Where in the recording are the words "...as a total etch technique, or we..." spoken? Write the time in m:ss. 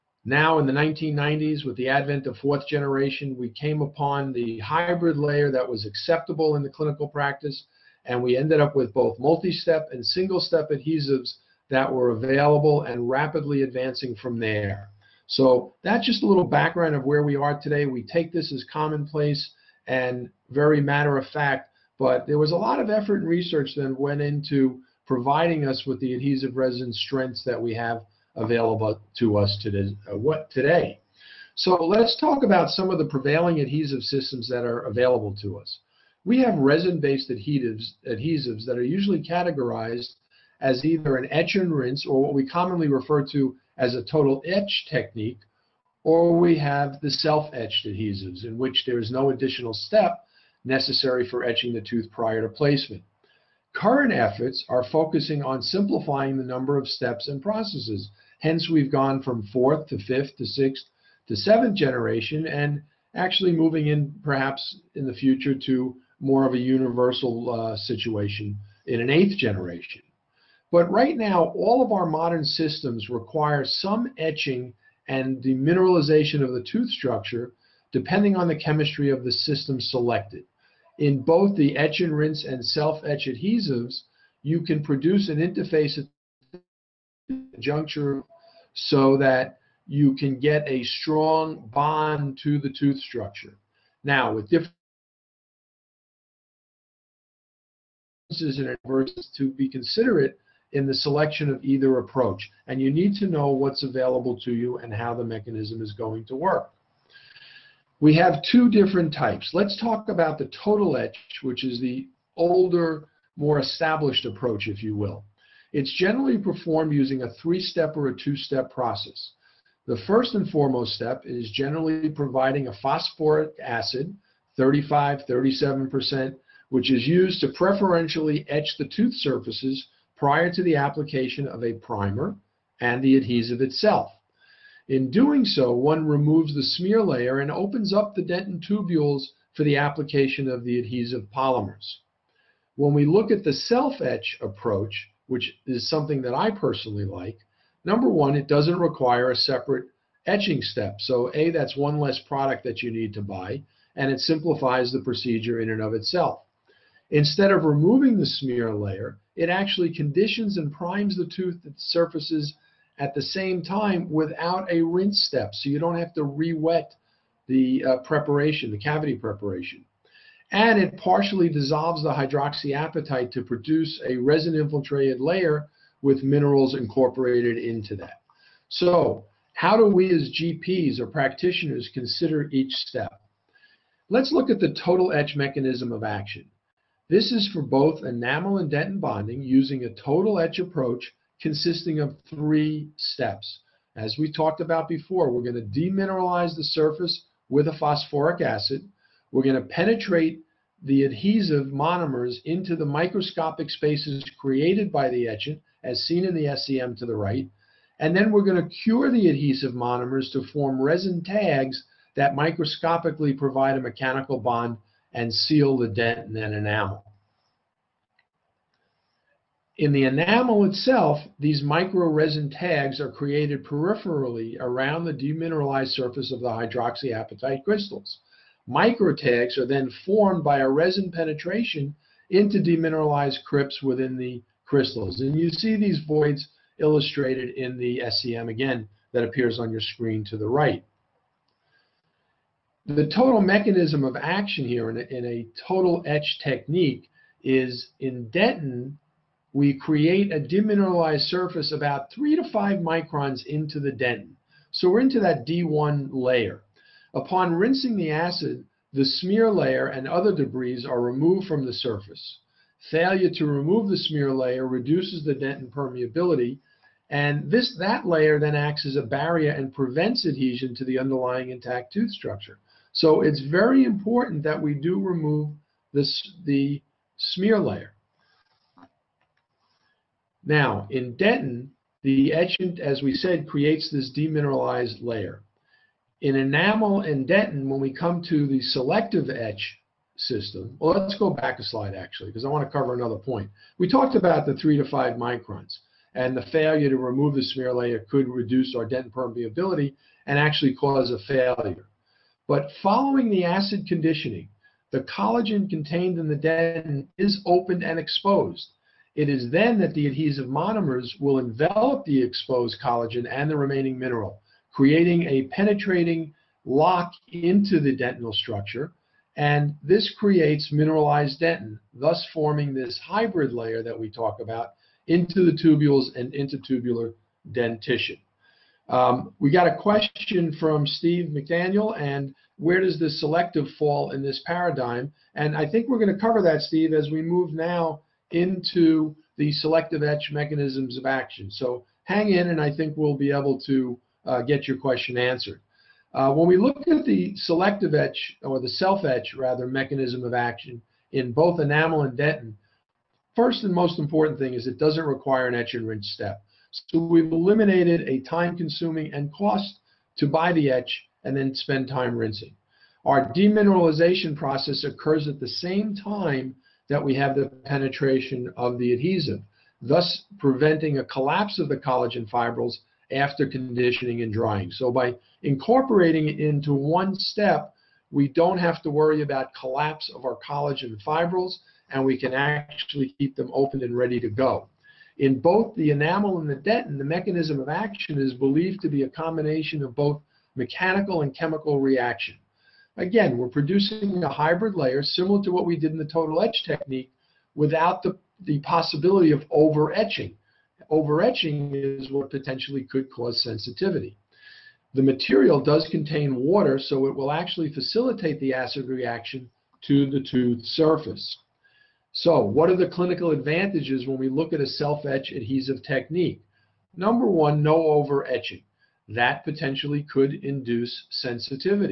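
0:43.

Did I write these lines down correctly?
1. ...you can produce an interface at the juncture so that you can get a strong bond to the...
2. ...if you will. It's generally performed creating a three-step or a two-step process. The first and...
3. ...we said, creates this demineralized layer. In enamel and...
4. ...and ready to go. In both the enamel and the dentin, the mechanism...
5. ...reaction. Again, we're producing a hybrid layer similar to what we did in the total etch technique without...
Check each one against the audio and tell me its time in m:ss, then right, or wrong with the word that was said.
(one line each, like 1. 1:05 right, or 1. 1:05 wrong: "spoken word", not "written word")
1. 1:24 right
2. 1:54 wrong: "using", not "creating"
3. 4:43 right
4. 6:23 right
5. 6:31 right.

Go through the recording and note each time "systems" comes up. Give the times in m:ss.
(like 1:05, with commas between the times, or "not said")
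0:34, 1:12, 1:19, 4:50.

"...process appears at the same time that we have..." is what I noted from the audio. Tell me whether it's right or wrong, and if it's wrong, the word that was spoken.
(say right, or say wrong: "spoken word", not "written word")
wrong: "occurs", not "appears".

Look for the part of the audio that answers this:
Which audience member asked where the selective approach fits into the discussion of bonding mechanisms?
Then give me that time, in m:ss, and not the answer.
5:30.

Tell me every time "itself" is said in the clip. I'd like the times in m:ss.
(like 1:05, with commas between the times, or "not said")
2:13, 2:35, 3:40.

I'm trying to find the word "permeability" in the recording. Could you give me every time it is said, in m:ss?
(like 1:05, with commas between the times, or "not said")
4:25, 4:59.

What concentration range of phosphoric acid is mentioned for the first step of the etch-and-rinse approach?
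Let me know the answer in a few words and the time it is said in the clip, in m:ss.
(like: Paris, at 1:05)
35, 37%, at 2:04.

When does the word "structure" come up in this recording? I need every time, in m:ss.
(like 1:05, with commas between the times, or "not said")
1:16, 1:32, 4:32, 5:18.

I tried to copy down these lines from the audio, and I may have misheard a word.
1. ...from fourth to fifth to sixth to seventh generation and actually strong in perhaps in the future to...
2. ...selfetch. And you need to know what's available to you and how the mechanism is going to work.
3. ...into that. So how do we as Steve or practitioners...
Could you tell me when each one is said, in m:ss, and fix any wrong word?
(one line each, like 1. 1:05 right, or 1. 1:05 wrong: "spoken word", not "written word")
1. 0:59 wrong: "moving", not "strong"
2. 1:41 wrong: "approach", not "selfetch"
3. 2:57 wrong: "GPs", not "Steve".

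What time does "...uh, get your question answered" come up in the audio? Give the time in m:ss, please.
5:44.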